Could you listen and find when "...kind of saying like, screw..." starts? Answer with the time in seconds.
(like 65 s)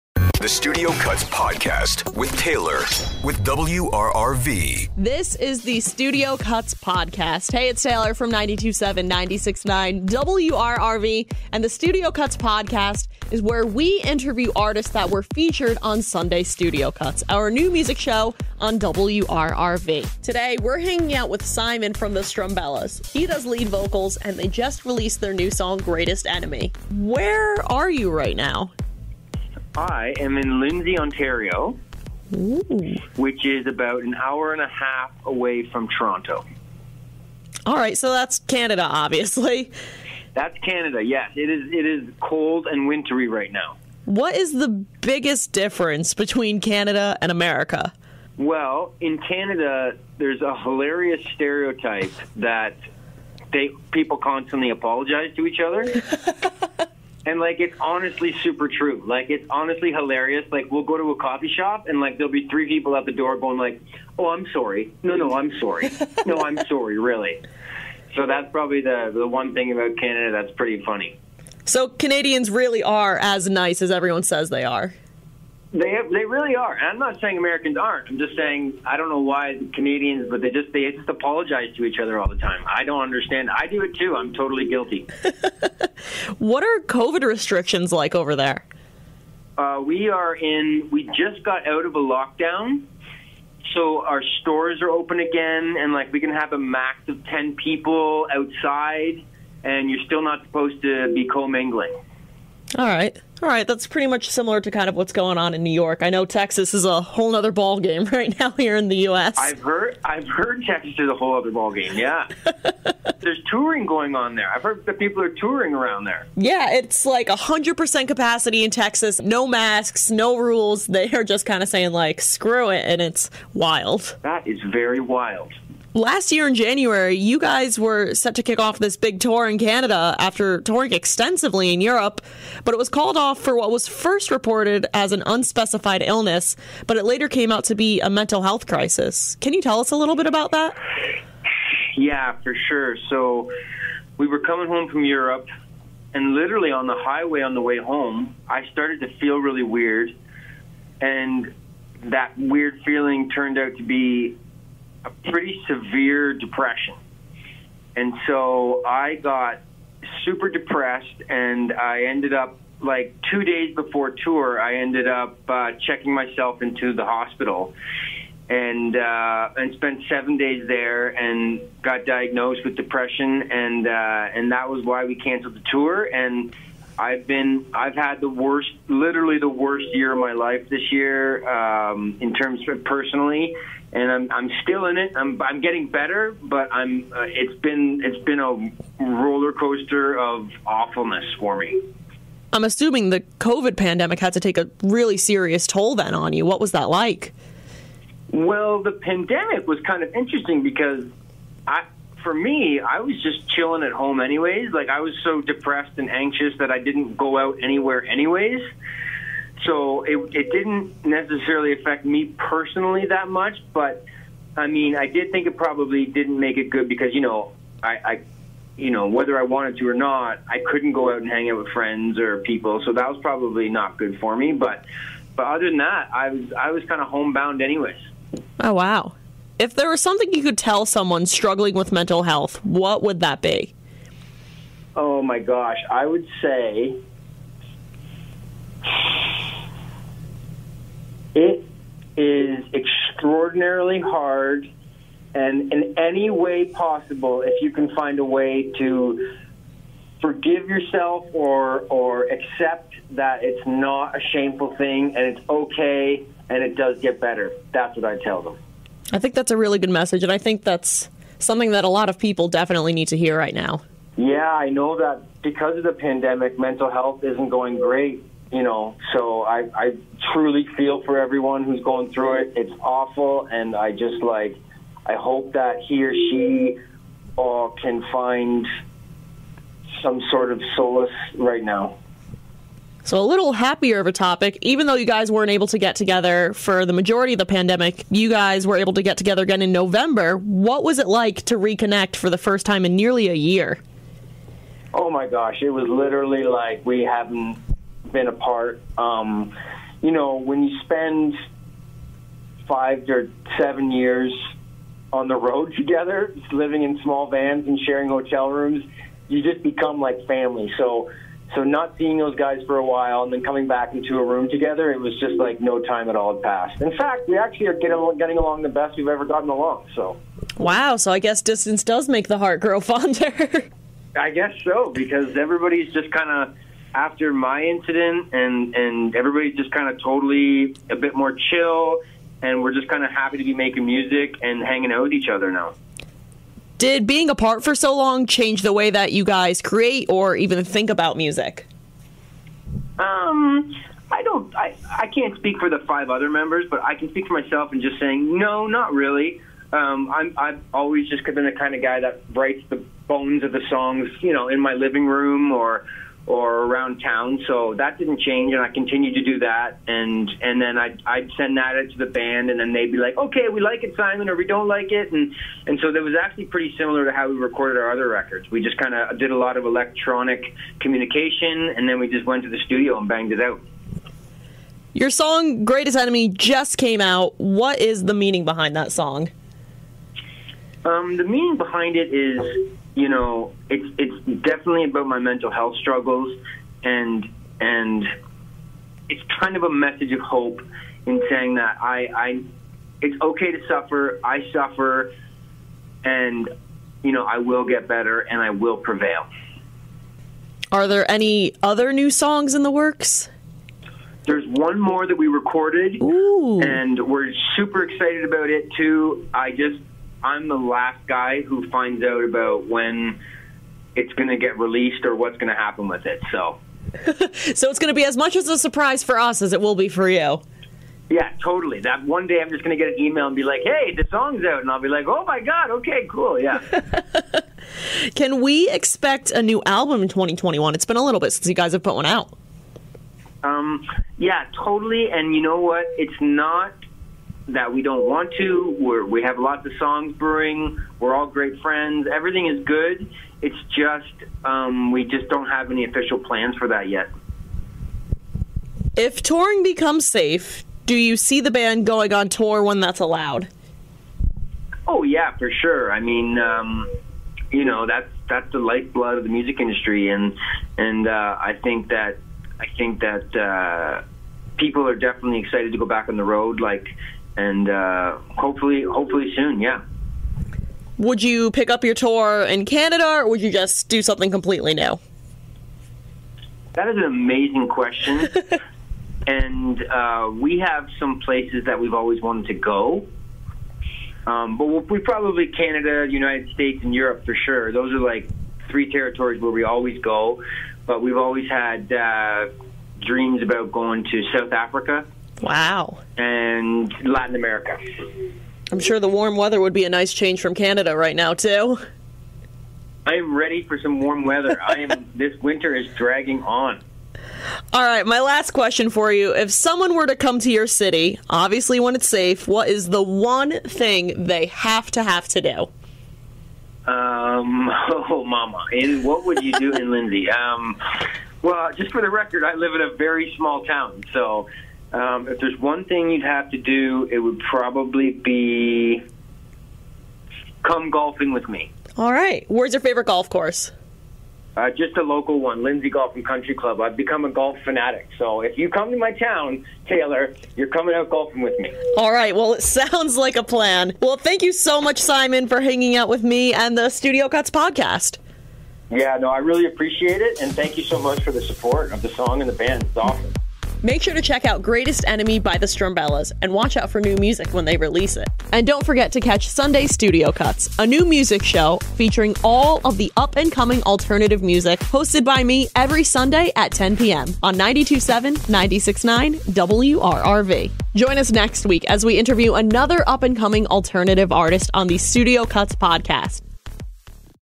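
121 s.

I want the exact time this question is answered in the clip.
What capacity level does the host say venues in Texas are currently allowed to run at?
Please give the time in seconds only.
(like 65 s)
117 s.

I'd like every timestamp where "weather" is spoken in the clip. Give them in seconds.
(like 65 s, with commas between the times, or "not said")
499 s, 504 s.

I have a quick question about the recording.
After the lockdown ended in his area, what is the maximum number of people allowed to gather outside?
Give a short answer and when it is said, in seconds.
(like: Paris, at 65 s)
10, at 97 s.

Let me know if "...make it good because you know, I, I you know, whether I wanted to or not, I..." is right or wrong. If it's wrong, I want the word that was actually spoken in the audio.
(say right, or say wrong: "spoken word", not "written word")
right.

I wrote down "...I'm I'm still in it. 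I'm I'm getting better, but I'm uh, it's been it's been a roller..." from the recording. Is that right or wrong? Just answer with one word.
right.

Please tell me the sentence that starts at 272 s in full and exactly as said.
It's awful, and I just like, I hope that he or she or uh, can find some sort of solace right now.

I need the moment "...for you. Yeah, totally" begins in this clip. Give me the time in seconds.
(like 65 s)
419 s.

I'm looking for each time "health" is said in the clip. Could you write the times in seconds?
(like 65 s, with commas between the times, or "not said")
138 s, 232 s, 266 s, 385 s.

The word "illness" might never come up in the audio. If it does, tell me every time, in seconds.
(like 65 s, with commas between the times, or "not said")
136 s.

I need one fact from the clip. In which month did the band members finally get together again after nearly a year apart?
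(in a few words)
November.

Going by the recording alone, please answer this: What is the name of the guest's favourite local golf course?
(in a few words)
Lindsay Golf and Country Club.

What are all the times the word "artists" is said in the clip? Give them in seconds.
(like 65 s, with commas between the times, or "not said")
14 s, 574 s.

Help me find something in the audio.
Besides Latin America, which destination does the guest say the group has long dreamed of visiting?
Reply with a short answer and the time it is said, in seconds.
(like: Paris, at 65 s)
South Africa, at 494 s.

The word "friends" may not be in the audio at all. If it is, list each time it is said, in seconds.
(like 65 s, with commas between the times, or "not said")
221 s, 441 s.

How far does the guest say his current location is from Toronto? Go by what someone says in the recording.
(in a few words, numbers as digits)
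an hour and a half.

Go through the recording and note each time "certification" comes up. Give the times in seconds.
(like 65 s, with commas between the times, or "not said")
not said.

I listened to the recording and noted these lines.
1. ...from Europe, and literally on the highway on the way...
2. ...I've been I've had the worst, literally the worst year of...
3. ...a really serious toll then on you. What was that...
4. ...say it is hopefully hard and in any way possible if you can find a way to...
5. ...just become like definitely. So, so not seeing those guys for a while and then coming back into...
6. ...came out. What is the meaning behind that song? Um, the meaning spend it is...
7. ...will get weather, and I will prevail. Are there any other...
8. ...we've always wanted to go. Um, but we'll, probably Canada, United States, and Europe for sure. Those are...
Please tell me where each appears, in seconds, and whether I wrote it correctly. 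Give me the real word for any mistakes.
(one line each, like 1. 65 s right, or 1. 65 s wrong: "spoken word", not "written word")
1. 144 s right
2. 177 s right
3. 194 s right
4. 236 s wrong: "extraordinarily", not "hopefully"
5. 309 s wrong: "family", not "definitely"
6. 376 s wrong: "behind", not "spend"
7. 397 s wrong: "better", not "weather"
8. 481 s right.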